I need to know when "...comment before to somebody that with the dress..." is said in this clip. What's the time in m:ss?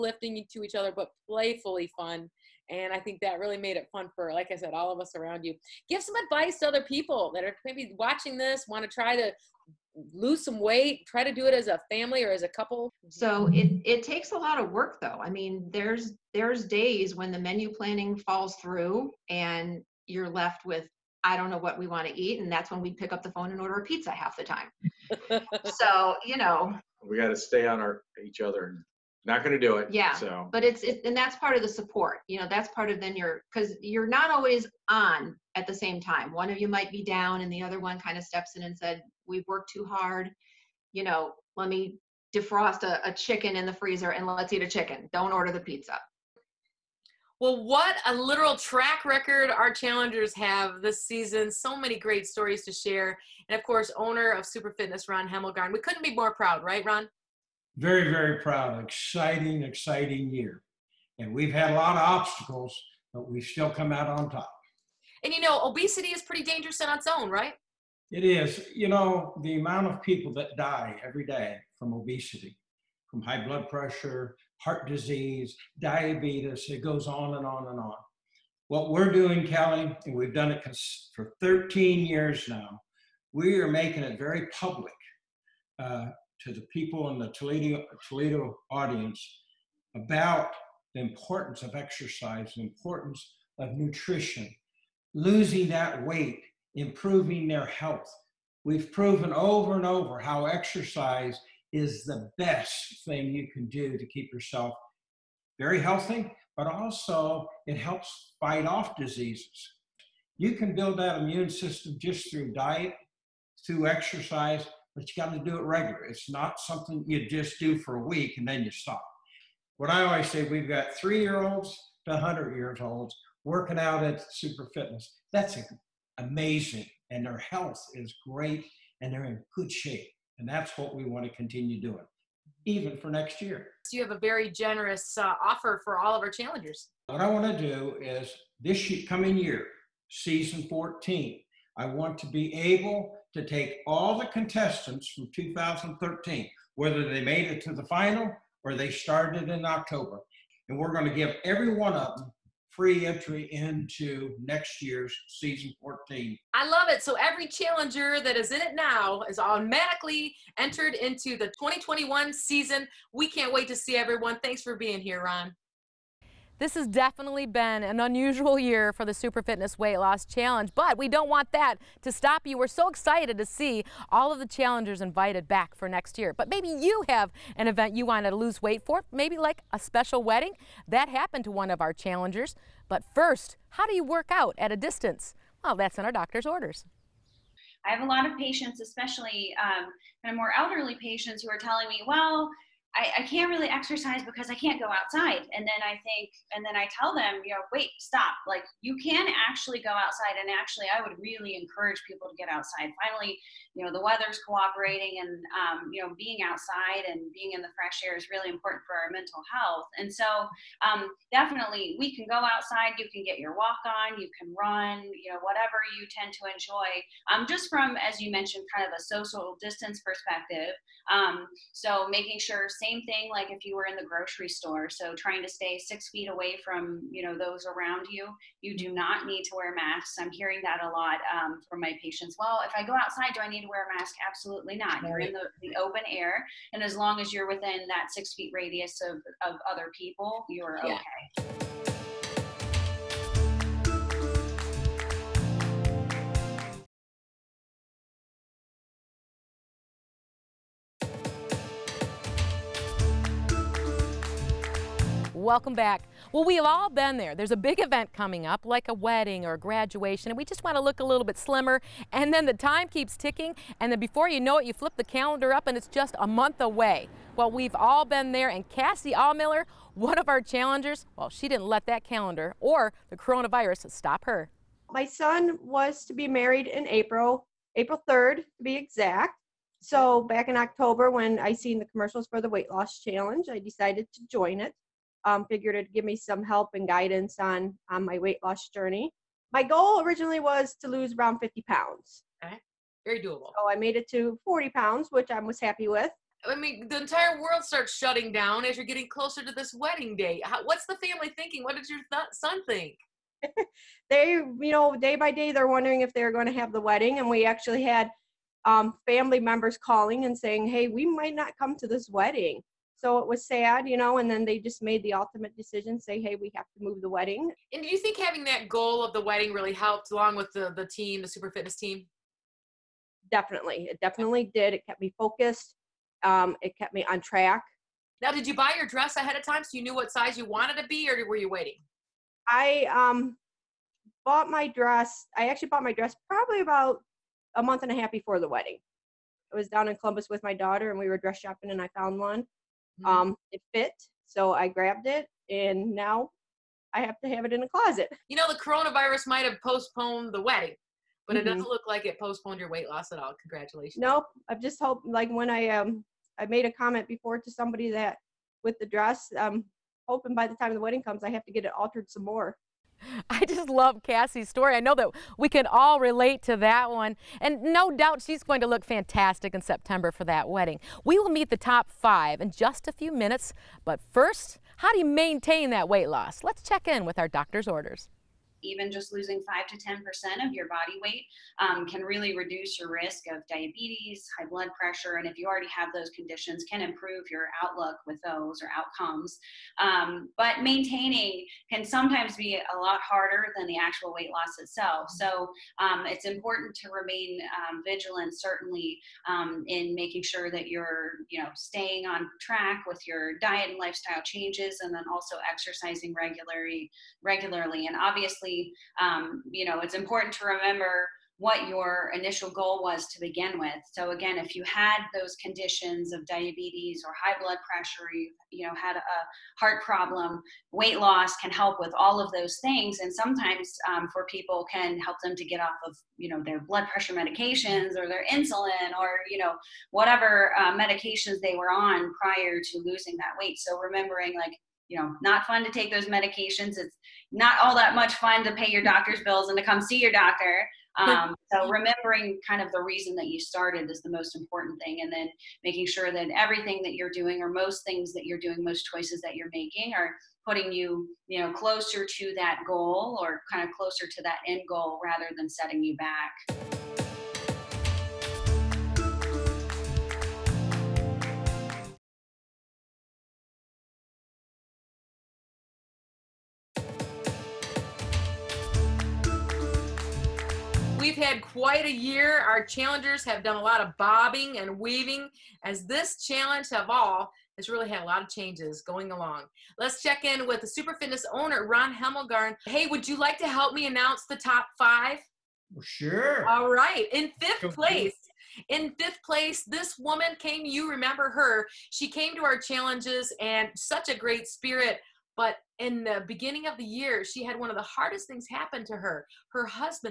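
5:56.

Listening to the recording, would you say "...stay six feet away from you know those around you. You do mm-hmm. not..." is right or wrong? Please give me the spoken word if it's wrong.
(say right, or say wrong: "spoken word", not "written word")
right.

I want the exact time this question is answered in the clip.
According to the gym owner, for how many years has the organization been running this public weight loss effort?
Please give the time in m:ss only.
1:21.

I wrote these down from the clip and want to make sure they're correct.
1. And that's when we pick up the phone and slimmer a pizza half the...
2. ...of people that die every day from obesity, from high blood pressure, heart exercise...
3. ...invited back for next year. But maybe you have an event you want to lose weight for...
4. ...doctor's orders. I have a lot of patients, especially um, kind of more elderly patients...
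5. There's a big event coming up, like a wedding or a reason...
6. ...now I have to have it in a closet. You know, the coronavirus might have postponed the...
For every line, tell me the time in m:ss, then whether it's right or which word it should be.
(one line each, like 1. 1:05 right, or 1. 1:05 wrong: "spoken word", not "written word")
1. 0:22 wrong: "order", not "slimmer"
2. 1:09 wrong: "disease", not "exercise"
3. 2:55 right
4. 3:06 right
5. 4:17 wrong: "graduation", not "reason"
6. 5:45 right.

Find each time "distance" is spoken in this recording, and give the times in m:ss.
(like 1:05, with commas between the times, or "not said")
3:04, 3:39.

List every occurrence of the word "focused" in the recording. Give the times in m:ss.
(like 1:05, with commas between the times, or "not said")
5:25.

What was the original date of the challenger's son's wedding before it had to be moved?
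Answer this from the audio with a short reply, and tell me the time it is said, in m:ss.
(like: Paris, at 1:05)
April 3rd, at 4:37.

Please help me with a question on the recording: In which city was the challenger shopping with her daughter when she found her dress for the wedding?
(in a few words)
Columbus.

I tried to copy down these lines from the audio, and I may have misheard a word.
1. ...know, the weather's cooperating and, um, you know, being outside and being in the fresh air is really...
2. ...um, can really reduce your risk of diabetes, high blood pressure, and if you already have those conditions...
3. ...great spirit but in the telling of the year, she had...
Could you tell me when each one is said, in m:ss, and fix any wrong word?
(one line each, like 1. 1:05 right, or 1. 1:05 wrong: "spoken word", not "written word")
1. 3:23 right
2. 6:21 right
3. 8:14 wrong: "beginning", not "telling".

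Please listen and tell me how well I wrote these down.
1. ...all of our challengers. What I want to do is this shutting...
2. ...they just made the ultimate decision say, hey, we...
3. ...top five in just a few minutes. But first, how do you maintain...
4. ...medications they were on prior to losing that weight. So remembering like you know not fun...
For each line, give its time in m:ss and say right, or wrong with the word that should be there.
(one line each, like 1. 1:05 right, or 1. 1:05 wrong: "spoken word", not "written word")
1. 2:15 wrong: "coming", not "shutting"
2. 5:14 right
3. 6:11 right
4. 7:10 right.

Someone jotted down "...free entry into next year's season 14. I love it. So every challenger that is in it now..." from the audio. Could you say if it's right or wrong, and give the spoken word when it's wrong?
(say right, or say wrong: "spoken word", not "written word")
right.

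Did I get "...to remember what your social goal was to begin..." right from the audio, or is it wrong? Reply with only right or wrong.
wrong.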